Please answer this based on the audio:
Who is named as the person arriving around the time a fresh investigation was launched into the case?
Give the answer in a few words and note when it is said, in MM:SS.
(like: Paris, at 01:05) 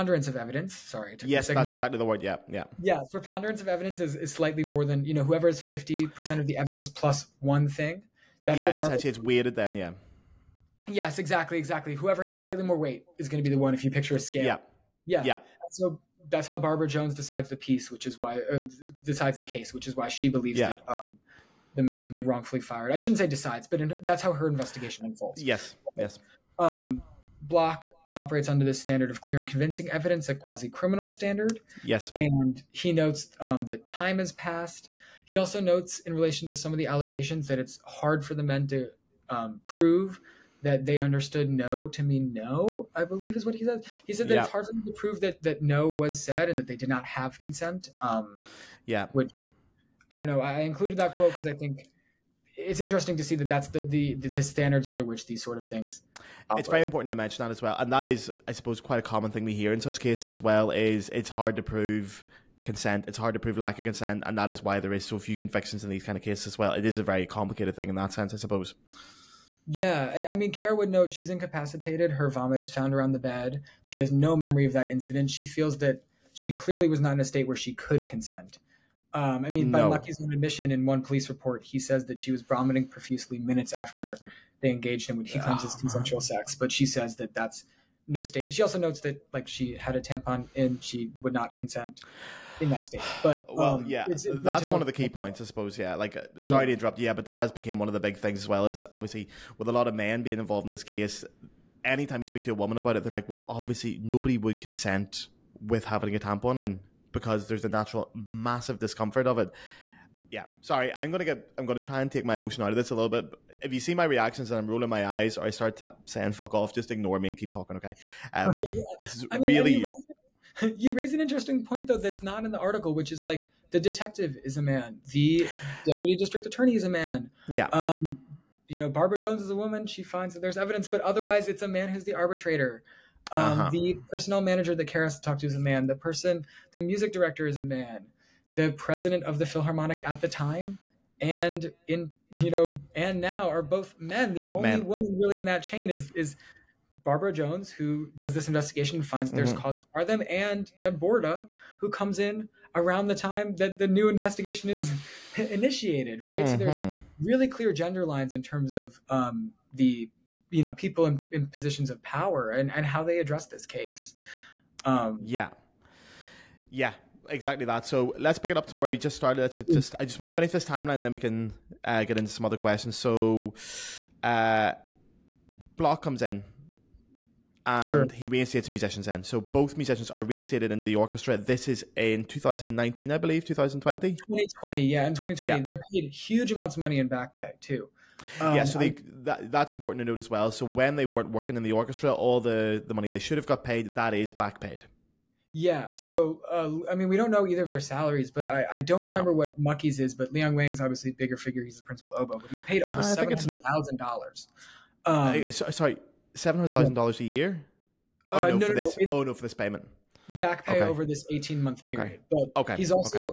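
Deb Borda, at 02:30.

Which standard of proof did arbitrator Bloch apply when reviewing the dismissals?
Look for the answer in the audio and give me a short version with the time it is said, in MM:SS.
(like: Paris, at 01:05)
clear and convincing evidence, at 00:29.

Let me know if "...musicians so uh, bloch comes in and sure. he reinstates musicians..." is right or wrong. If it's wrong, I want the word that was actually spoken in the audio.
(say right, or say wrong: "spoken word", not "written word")
wrong: "questions", not "musicians".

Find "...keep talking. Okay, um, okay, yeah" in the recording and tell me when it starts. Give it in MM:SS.
01:57.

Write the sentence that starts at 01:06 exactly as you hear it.
It is a very complicated thing in that sense, I suppose.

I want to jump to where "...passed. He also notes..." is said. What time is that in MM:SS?
00:34.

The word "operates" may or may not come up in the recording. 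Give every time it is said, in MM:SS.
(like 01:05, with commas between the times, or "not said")
00:28, 00:56.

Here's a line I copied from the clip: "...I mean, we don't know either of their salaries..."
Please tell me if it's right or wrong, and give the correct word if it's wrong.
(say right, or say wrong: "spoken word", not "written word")
right.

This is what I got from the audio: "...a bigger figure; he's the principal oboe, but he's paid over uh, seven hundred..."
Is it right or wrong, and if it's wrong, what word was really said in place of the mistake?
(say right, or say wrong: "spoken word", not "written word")
right.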